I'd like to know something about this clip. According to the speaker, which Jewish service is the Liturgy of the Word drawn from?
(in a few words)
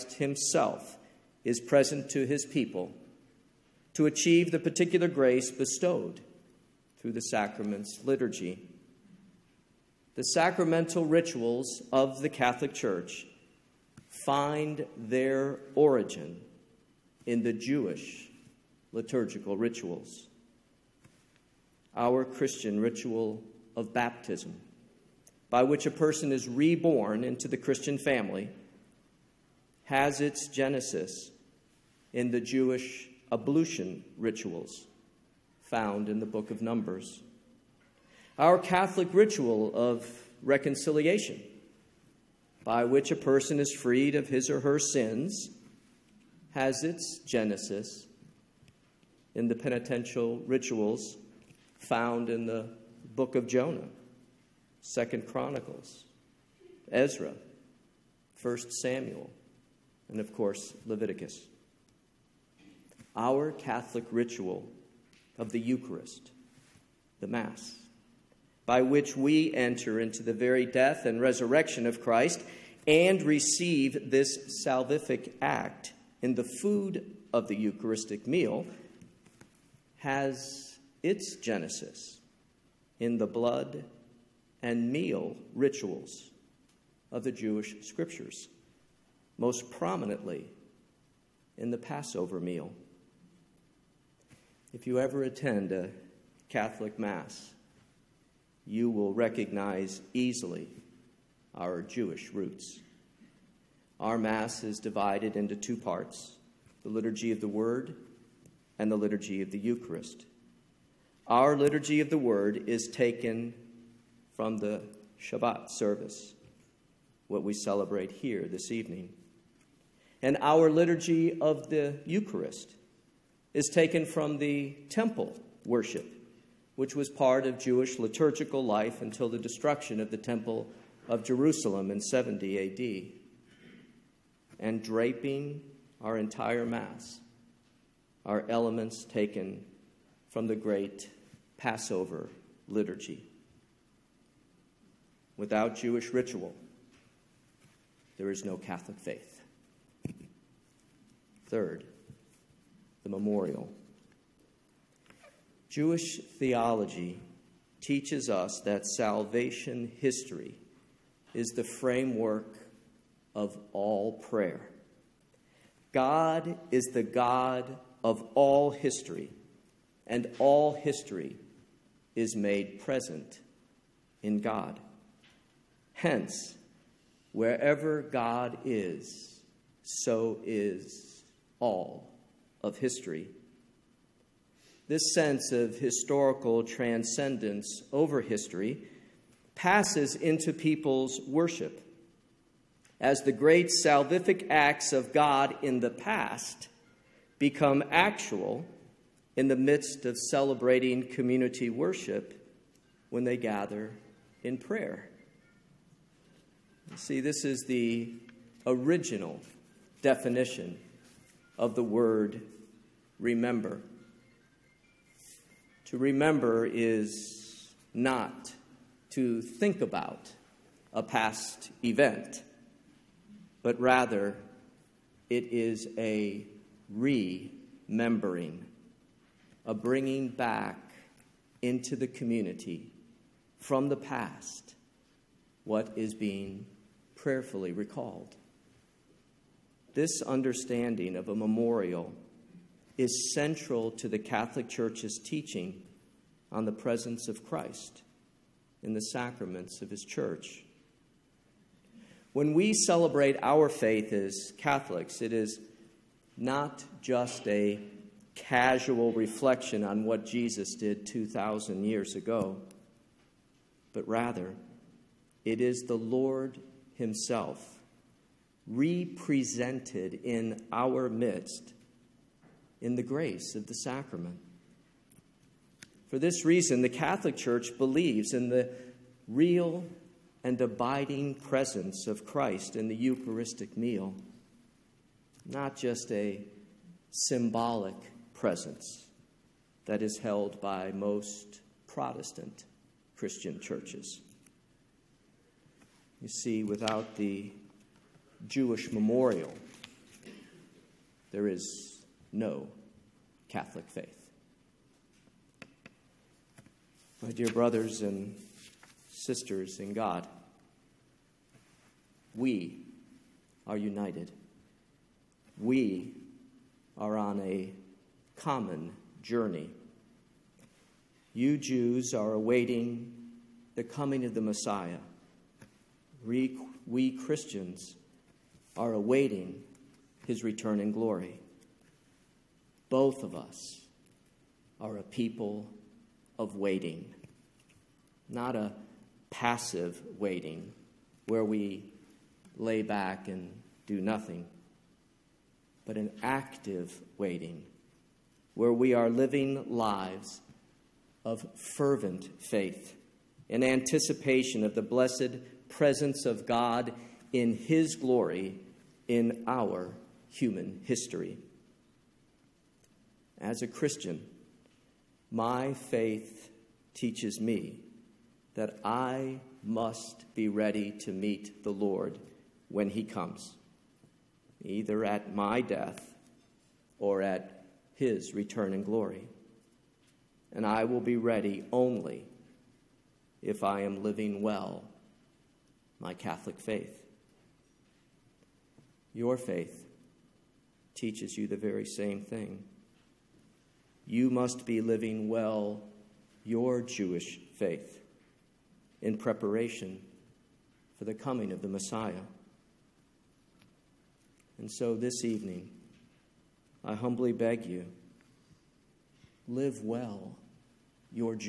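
Shabbat service.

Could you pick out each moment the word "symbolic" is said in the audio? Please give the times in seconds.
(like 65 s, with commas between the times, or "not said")
287 s.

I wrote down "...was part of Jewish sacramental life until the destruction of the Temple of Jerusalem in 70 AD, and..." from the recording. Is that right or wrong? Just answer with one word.
wrong.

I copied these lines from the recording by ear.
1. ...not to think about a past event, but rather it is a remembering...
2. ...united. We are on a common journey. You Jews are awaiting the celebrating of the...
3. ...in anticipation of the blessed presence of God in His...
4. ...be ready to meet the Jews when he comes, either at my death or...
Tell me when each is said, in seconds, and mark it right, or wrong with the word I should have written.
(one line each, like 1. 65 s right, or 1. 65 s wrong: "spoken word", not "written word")
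1. 217 s right
2. 313 s wrong: "coming", not "celebrating"
3. 353 s right
4. 370 s wrong: "Lord", not "Jews".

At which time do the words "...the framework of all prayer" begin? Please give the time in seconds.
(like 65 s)
161 s.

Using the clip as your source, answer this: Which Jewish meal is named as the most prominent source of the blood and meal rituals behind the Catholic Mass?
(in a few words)
Passover meal.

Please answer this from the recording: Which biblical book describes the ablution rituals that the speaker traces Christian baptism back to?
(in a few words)
Numbers.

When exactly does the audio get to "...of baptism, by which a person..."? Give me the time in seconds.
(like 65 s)
23 s.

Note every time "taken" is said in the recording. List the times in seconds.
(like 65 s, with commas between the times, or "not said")
112 s, 123 s, 139 s.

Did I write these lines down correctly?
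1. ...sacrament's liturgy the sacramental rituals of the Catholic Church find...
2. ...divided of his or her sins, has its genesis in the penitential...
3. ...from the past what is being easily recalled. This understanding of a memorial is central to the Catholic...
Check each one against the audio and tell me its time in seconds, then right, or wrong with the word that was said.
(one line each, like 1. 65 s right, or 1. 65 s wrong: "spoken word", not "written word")
1. 7 s right
2. 43 s wrong: "freed", not "divided"
3. 233 s wrong: "prayerfully", not "easily".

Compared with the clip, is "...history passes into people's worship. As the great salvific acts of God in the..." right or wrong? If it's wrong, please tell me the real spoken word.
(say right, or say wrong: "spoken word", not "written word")
right.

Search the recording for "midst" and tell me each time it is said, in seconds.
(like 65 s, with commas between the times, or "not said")
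199 s, 271 s.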